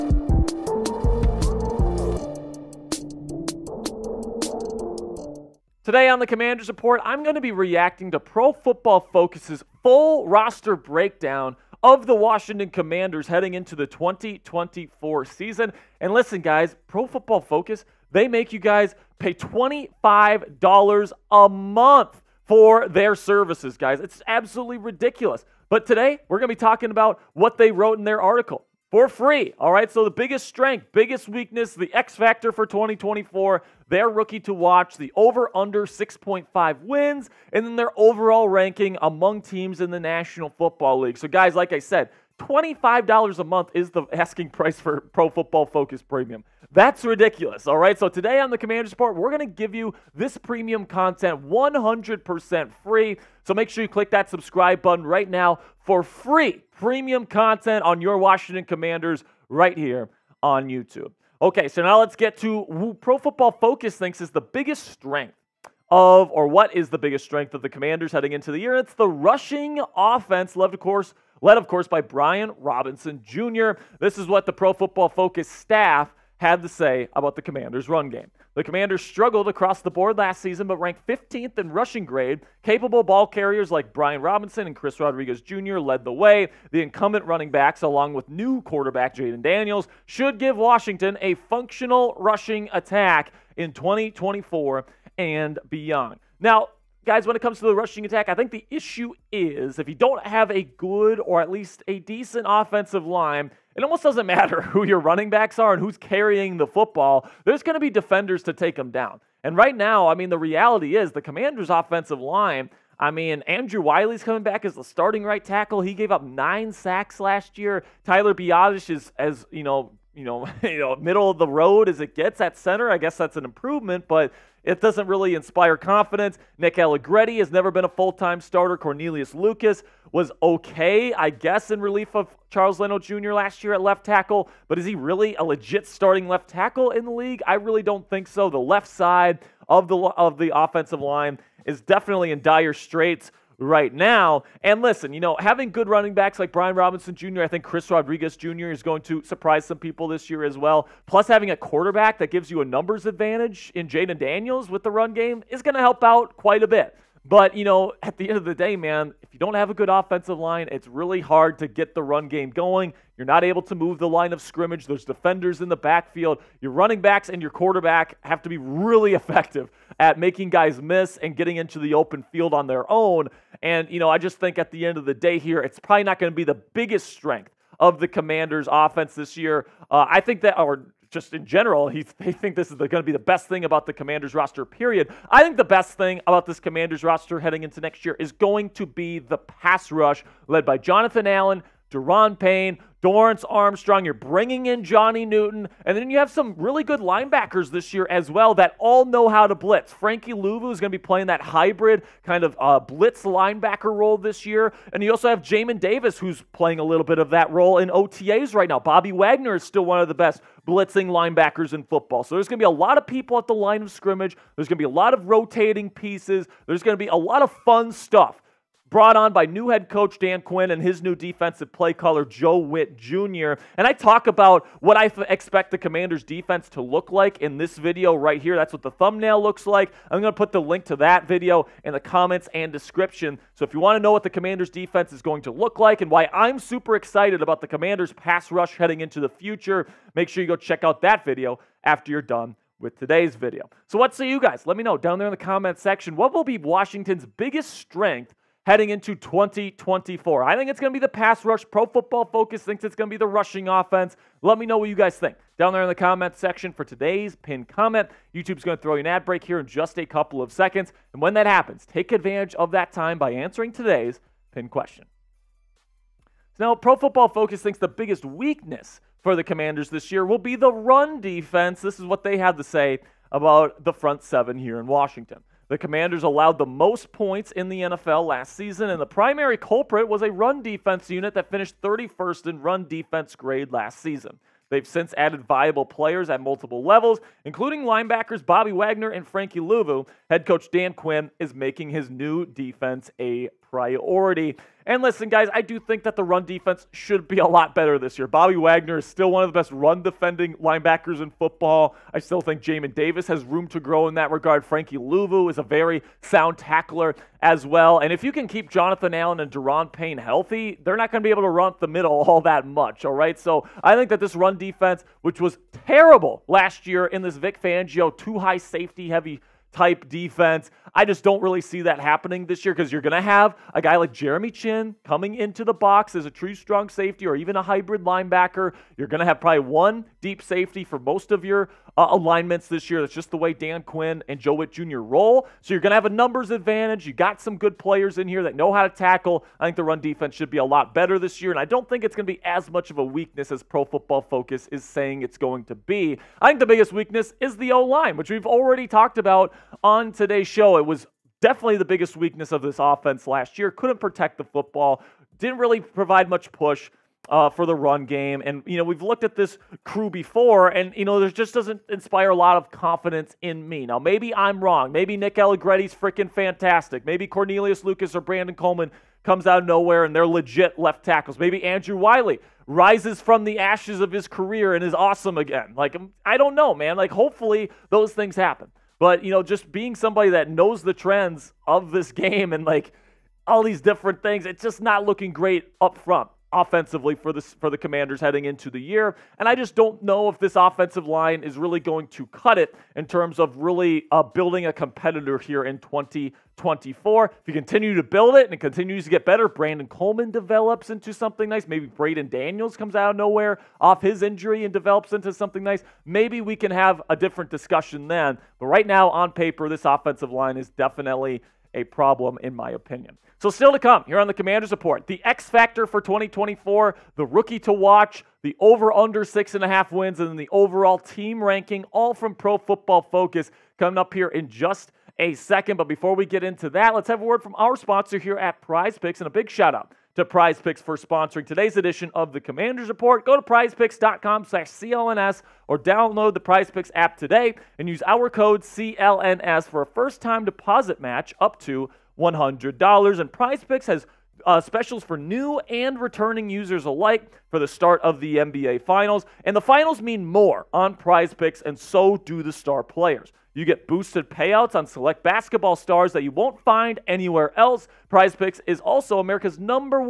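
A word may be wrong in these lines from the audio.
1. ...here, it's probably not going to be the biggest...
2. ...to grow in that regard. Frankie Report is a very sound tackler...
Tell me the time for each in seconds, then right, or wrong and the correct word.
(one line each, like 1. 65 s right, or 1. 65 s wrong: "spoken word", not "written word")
1. 175 s right
2. 303 s wrong: "Luvu", not "Report".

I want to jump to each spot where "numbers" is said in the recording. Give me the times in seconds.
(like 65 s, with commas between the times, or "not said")
152 s, 336 s, 459 s.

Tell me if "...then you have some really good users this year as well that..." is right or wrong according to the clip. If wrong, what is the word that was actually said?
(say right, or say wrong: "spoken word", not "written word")
wrong: "linebackers", not "users".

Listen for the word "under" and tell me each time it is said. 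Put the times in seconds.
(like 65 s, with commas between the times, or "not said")
35 s, 418 s.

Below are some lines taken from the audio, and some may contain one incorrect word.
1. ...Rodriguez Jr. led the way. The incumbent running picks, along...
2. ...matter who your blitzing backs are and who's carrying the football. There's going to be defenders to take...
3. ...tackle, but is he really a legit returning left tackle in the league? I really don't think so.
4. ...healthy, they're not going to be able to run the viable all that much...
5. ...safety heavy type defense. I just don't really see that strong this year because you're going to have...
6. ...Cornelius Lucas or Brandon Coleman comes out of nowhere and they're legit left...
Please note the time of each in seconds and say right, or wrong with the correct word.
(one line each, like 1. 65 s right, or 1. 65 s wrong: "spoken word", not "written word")
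1. 84 s wrong: "backs", not "picks"
2. 104 s wrong: "running", not "blitzing"
3. 134 s wrong: "starting", not "returning"
4. 310 s wrong: "middle", not "viable"
5. 318 s wrong: "happening", not "strong"
6. 367 s right.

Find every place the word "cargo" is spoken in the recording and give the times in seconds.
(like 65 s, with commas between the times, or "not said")
not said.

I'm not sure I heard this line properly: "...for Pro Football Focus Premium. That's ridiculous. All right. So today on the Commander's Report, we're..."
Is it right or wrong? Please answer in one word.
right.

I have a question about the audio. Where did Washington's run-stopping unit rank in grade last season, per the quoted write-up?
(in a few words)
31st.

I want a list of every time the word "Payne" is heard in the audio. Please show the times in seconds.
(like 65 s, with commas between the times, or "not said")
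192 s, 309 s.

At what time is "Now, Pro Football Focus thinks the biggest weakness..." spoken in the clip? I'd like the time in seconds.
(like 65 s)
266 s.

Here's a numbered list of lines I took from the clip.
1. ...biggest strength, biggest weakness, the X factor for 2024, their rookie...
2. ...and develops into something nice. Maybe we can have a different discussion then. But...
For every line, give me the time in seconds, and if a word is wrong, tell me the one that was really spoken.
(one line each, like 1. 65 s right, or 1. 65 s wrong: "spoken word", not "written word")
1. 30 s right
2. 404 s right.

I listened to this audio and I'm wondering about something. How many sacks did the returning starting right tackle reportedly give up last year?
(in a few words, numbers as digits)
9.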